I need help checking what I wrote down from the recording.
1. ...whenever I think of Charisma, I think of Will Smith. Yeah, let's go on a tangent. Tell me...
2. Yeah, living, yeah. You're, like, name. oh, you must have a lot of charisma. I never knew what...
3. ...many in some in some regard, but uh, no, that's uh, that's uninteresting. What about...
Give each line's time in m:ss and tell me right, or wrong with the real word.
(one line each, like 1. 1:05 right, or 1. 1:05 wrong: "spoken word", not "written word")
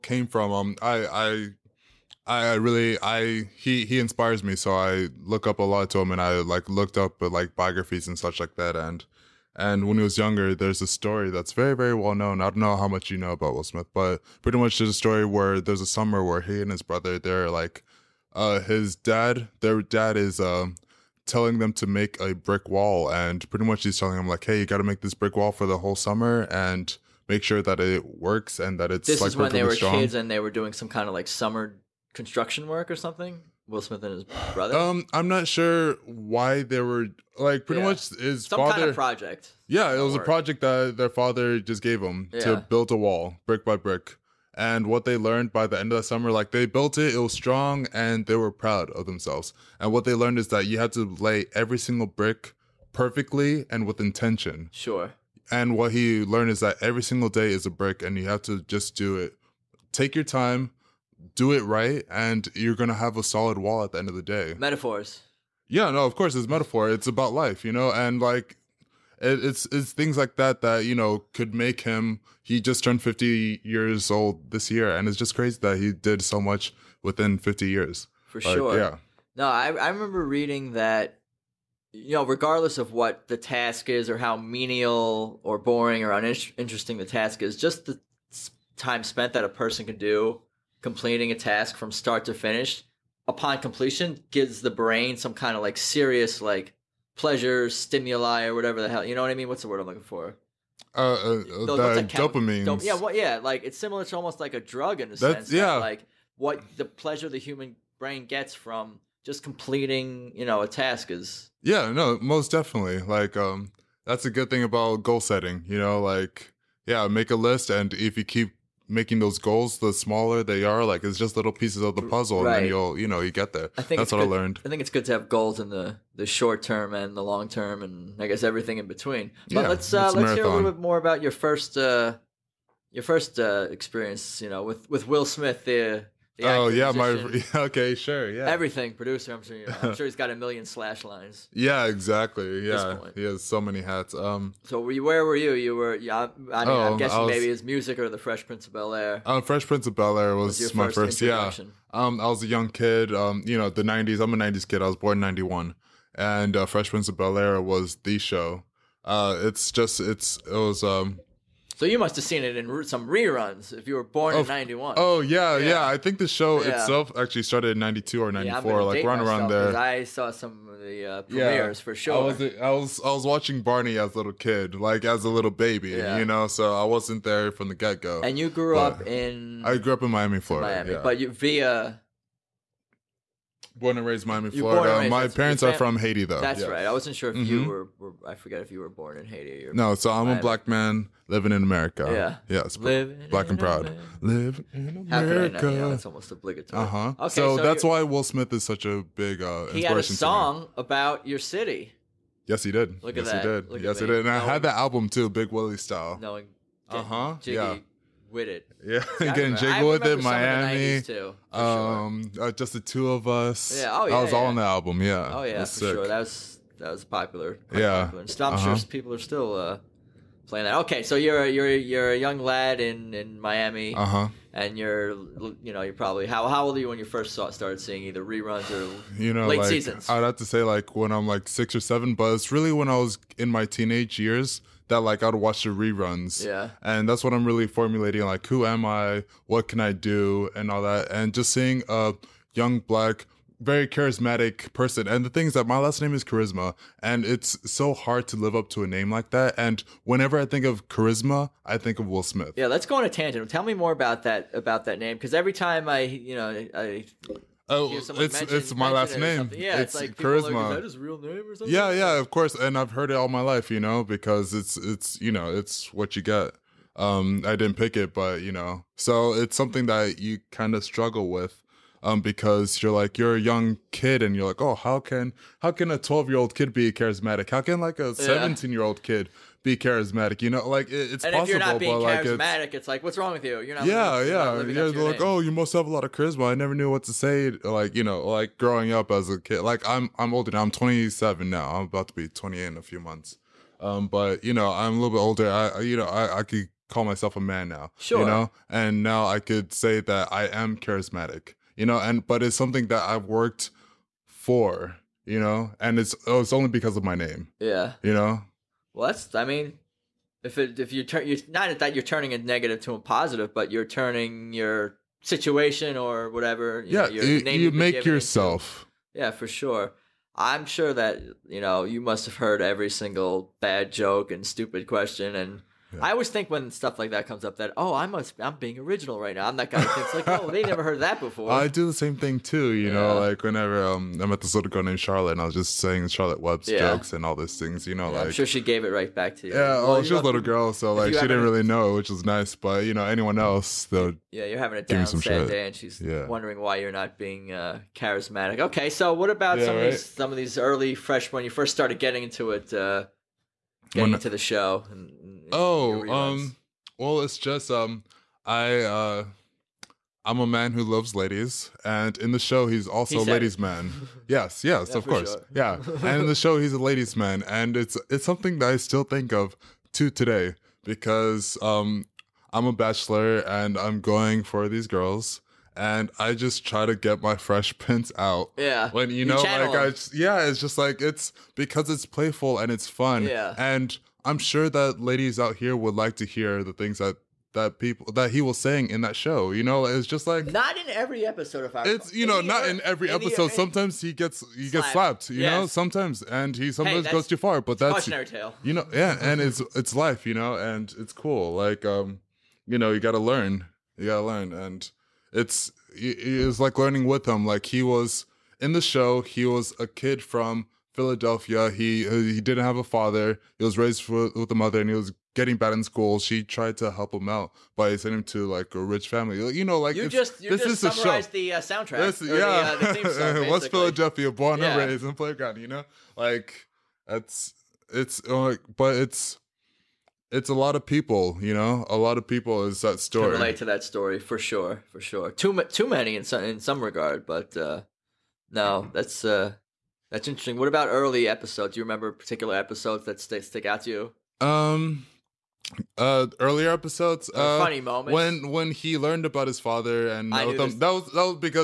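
1. 4:10 right
2. 4:43 right
3. 7:15 wrong: "interesting", not "uninteresting".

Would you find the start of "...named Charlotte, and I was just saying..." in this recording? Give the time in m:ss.
5:34.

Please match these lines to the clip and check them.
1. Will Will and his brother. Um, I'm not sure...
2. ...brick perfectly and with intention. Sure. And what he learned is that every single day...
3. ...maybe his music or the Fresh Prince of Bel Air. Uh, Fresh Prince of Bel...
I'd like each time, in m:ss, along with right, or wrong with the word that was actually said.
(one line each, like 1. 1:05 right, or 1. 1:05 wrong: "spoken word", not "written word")
1. 0:33 wrong: "Smith", not "Will"
2. 0:52 right
3. 2:27 right.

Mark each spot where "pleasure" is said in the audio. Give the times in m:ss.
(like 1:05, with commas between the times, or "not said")
1:37, 1:46.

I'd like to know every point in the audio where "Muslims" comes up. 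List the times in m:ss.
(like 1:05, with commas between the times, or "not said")
not said.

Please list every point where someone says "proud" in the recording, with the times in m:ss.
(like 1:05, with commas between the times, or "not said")
0:48, 3:13.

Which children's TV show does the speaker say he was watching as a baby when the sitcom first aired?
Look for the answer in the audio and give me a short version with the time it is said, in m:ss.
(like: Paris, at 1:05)
Barney, at 2:53.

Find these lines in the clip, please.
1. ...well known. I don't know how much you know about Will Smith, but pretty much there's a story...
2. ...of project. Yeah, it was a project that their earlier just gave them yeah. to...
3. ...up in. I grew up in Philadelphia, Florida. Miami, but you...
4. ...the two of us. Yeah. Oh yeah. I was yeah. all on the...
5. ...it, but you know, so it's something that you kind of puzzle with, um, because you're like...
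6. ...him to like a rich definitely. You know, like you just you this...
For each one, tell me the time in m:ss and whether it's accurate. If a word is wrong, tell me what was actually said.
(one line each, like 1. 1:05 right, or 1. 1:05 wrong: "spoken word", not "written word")
1. 0:11 right
2. 0:38 wrong: "father", not "earlier"
3. 2:58 wrong: "Miami", not "Philadelphia"
4. 3:32 right
5. 4:27 wrong: "struggle", not "puzzle"
6. 6:58 wrong: "family", not "definitely".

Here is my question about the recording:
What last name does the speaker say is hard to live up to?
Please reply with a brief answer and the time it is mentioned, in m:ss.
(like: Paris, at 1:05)
Carisma, at 4:06.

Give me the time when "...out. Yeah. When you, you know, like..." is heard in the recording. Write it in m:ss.
6:18.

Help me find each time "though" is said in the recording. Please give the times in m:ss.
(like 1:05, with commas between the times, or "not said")
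3:06, 5:43.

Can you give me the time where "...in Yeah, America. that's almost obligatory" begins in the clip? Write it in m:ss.
3:14.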